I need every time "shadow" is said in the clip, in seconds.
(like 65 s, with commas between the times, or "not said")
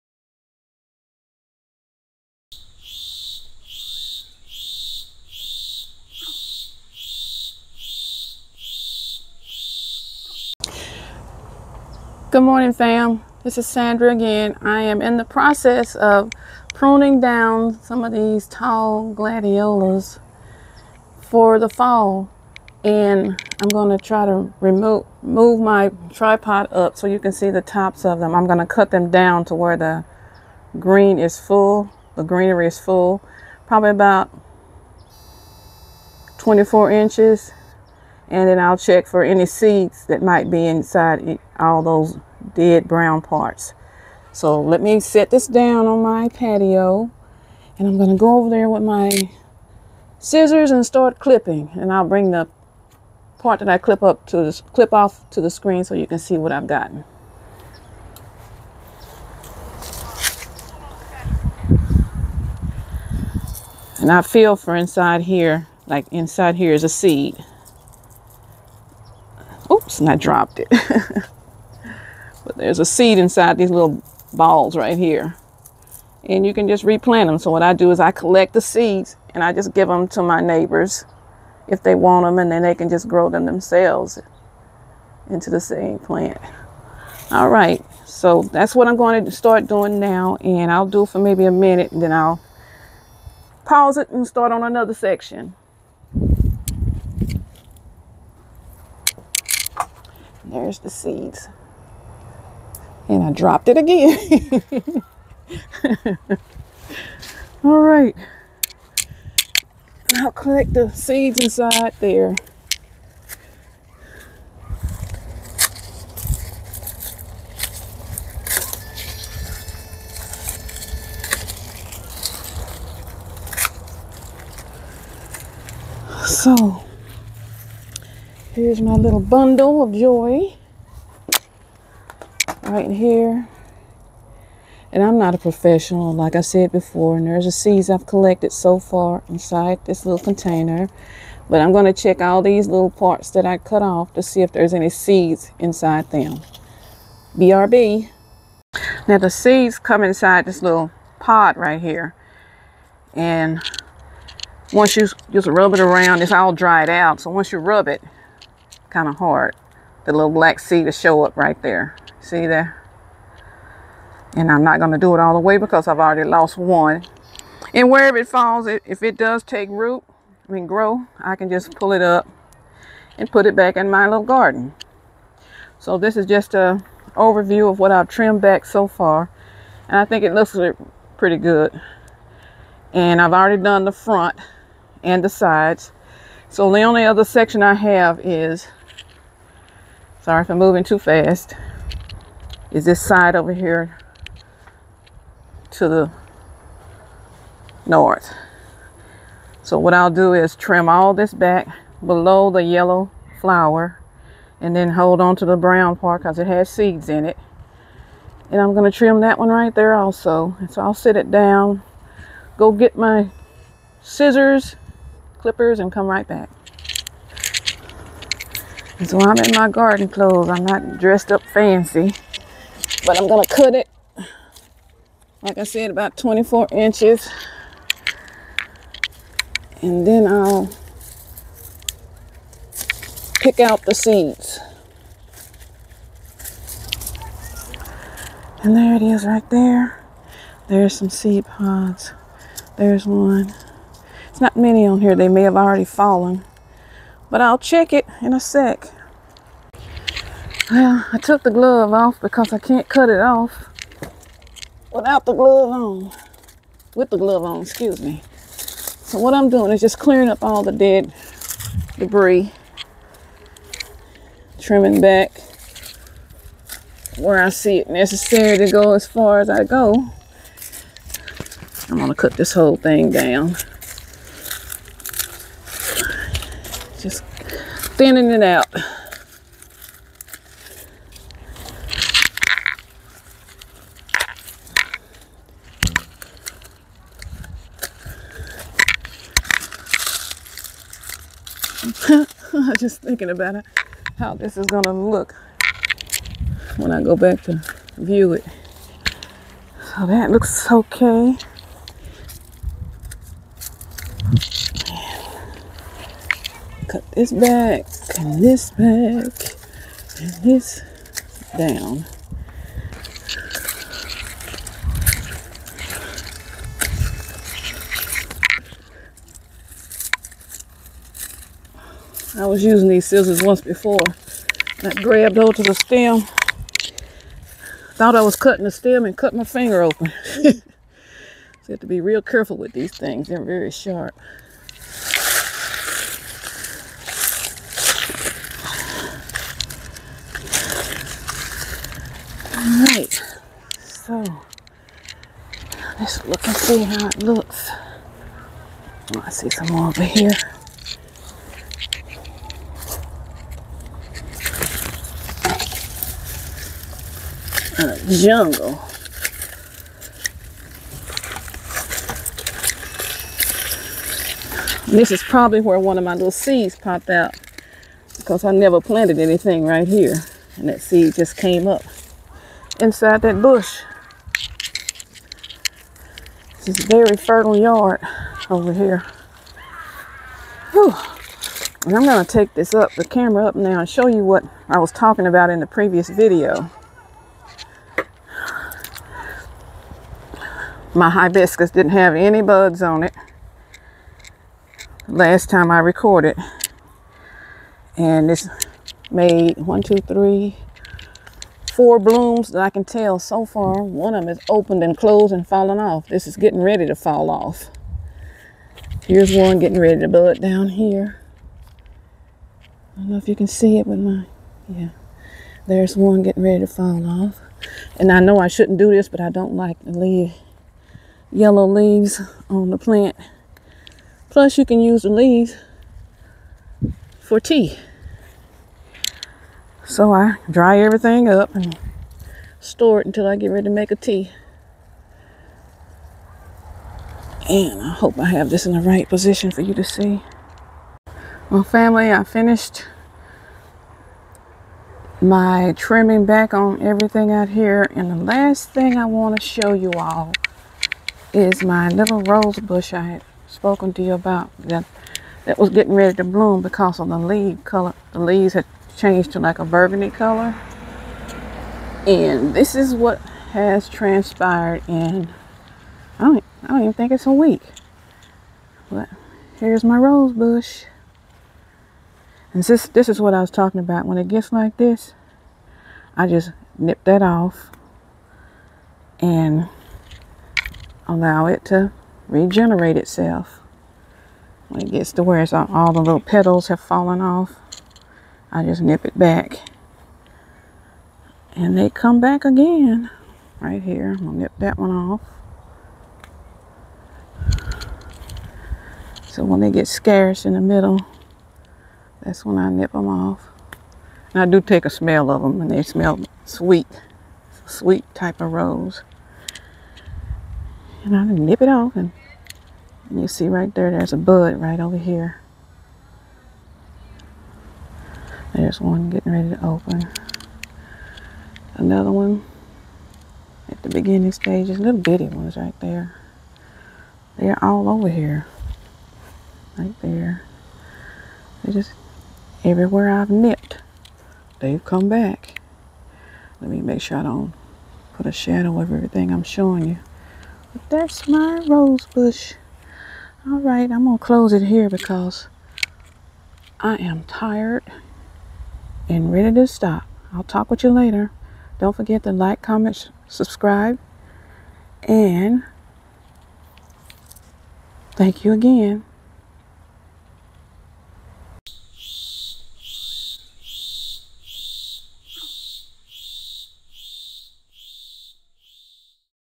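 538 s.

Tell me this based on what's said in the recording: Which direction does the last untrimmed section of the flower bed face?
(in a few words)
north.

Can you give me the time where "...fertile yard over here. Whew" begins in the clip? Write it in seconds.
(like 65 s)
377 s.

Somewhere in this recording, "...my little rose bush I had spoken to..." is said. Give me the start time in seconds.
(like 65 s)
451 s.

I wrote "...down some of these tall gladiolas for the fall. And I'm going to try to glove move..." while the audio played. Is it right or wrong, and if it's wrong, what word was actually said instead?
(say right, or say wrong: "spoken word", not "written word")
wrong: "remove", not "glove".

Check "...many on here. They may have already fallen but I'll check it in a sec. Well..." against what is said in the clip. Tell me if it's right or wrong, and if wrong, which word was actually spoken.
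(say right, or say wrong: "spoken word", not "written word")
right.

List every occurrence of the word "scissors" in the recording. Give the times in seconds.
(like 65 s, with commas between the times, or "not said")
50 s, 214 s, 323 s.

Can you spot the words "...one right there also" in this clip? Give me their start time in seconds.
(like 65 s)
209 s.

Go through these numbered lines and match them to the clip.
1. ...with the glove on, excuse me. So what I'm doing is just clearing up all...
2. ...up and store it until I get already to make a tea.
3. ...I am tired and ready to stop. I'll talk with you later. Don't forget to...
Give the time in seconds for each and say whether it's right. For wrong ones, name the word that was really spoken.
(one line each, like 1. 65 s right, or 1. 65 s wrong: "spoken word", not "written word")
1. 256 s right
2. 431 s wrong: "ready", not "already"
3. 546 s right.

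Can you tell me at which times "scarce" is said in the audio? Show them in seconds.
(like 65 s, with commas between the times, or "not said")
499 s.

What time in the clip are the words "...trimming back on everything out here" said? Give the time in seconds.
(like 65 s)
445 s.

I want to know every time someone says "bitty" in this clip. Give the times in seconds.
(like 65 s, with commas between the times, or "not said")
524 s.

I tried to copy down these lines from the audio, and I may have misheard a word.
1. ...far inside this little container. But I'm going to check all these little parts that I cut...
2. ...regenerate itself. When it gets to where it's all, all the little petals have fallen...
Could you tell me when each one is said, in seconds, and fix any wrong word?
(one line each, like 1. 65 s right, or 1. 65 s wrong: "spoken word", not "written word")
1. 138 s right
2. 482 s right.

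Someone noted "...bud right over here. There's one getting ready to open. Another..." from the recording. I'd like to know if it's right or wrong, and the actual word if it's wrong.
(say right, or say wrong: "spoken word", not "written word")
right.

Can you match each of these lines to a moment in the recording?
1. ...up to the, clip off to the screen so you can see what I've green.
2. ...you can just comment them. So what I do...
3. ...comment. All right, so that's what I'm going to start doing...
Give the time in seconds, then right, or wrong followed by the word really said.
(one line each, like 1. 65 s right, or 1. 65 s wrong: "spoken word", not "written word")
1. 54 s wrong: "gotten", not "green"
2. 76 s wrong: "replant", not "comment"
3. 85 s wrong: "plant", not "comment".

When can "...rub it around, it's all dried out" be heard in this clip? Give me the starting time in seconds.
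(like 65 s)
155 s.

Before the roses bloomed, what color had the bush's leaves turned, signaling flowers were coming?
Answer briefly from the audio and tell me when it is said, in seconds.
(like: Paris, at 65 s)
burgundy, at 459 s.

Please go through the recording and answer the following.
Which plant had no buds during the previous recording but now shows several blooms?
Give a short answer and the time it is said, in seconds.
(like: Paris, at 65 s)
hibiscus, at 391 s.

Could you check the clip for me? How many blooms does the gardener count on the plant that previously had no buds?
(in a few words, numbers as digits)
4.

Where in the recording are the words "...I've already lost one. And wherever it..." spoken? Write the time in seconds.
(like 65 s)
165 s.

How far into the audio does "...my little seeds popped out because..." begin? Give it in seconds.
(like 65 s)
366 s.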